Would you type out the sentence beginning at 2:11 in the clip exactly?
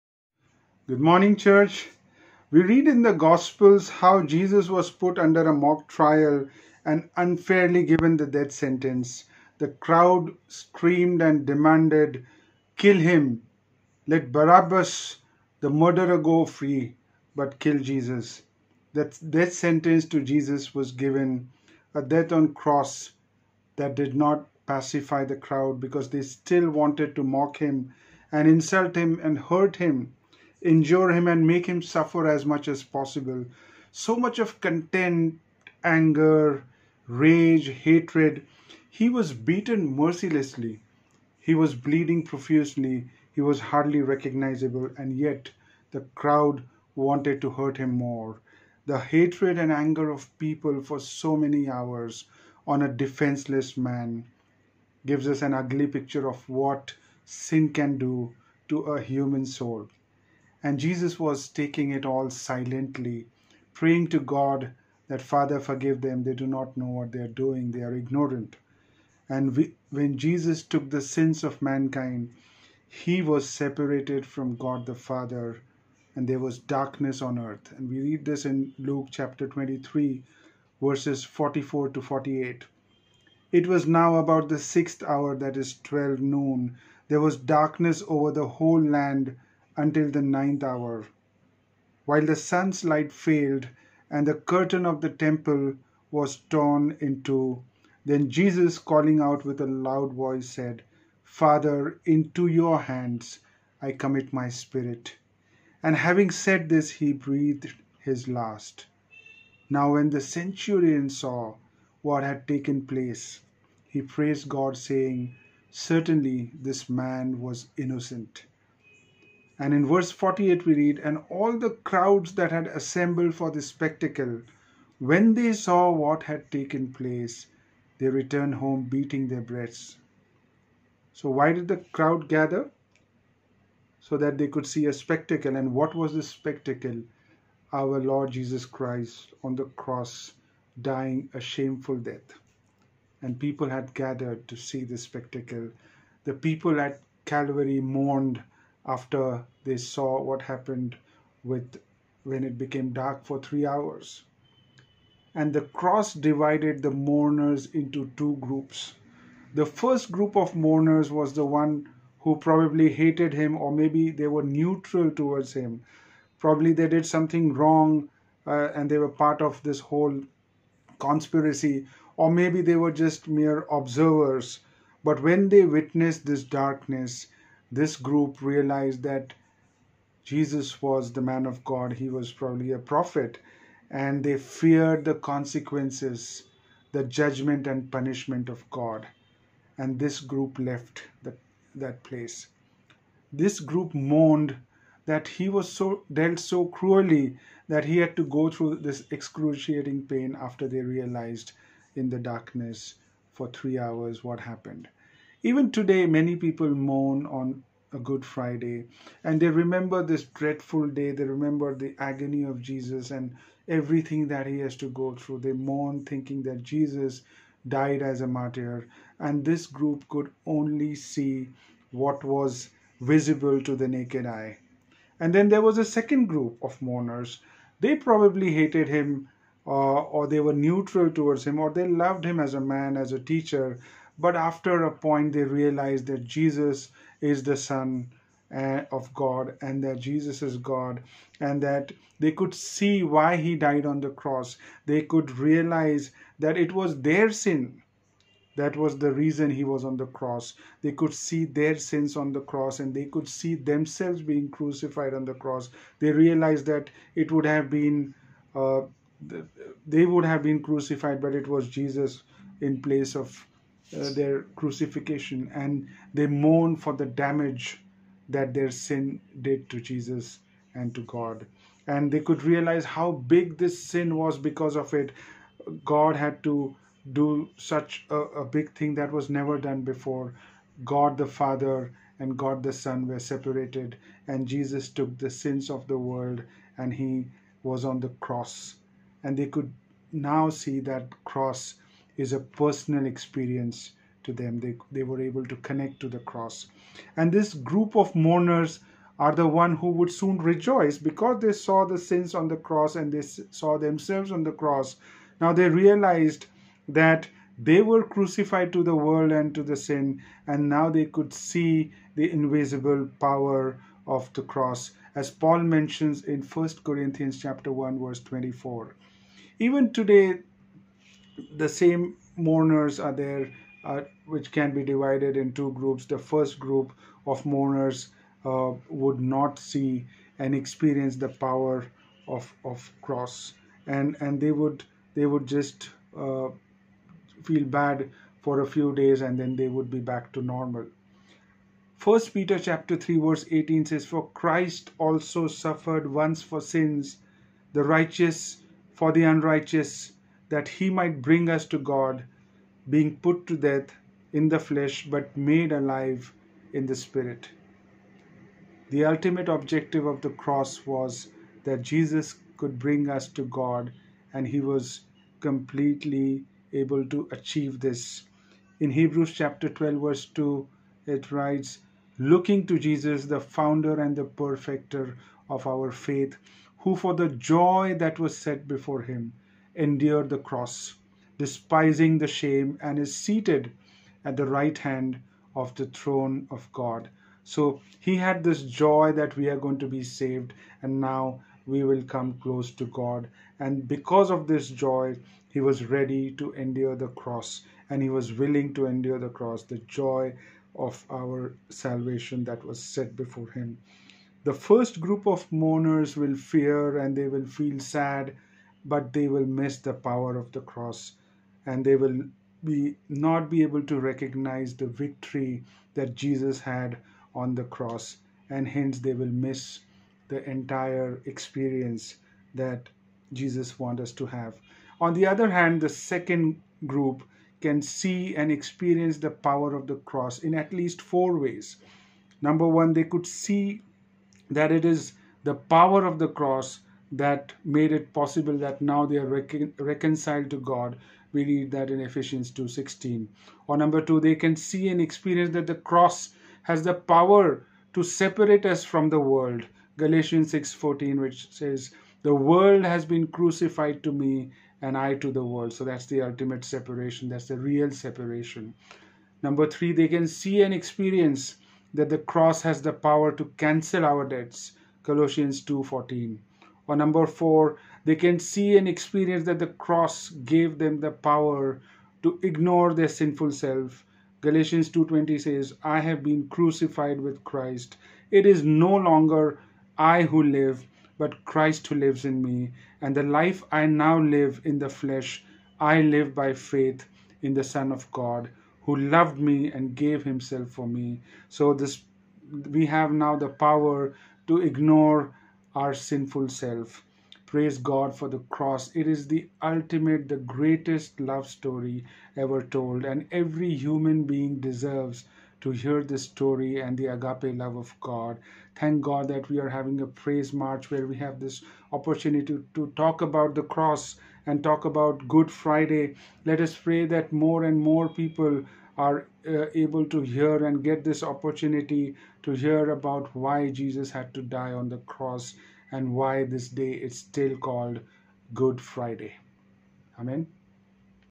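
So, why did the crowd gather?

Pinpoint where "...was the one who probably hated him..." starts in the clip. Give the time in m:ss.
2:41.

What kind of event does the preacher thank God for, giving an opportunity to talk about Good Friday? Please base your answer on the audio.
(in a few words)
praise march.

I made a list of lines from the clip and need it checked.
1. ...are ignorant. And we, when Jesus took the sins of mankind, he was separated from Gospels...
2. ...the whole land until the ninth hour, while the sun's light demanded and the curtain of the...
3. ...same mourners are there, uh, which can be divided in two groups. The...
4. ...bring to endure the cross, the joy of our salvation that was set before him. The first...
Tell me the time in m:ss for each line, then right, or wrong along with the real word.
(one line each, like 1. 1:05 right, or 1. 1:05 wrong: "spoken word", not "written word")
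1. 1:07 wrong: "God", not "Gospels"
2. 1:28 wrong: "failed", not "demanded"
3. 5:21 right
4. 6:38 wrong: "willing", not "bring".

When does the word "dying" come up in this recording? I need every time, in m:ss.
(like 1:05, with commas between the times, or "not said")
2:20.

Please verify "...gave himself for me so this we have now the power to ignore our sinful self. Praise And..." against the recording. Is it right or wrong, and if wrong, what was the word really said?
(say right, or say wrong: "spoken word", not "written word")
wrong: "God", not "And".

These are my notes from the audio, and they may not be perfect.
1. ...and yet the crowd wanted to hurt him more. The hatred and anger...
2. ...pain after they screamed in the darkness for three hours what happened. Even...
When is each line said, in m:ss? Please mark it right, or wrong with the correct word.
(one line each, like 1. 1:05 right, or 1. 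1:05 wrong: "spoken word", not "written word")
1. 0:44 right
2. 3:20 wrong: "realized", not "screamed".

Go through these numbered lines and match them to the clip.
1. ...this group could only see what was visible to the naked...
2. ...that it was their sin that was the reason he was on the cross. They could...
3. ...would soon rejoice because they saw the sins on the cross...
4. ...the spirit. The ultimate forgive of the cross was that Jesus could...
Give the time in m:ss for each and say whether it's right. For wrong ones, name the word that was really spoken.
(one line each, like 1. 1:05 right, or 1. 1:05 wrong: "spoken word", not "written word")
1. 3:39 right
2. 4:06 right
3. 4:59 right
4. 5:56 wrong: "objective", not "forgive".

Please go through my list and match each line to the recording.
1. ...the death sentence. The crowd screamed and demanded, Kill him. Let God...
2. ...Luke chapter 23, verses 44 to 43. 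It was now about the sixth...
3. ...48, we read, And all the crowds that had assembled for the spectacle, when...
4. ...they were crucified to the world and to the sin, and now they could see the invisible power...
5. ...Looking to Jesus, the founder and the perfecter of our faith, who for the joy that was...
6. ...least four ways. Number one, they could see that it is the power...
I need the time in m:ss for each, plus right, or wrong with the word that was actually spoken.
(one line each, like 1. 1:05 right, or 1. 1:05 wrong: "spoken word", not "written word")
1. 0:08 wrong: "Barabbas", not "God"
2. 1:18 wrong: "48", not "43"
3. 2:00 right
4. 5:07 right
5. 6:12 right
6. 7:10 right.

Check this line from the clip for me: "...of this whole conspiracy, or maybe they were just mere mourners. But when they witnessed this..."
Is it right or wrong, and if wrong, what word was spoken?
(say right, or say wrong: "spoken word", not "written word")
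wrong: "observers", not "mourners".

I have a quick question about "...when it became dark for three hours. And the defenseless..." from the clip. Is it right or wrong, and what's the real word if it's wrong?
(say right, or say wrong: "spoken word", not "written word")
wrong: "cross", not "defenseless".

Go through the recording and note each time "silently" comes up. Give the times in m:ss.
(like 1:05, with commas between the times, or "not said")
1:02.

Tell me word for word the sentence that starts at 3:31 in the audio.
They remember the agony of Jesus and everything that he has to go through.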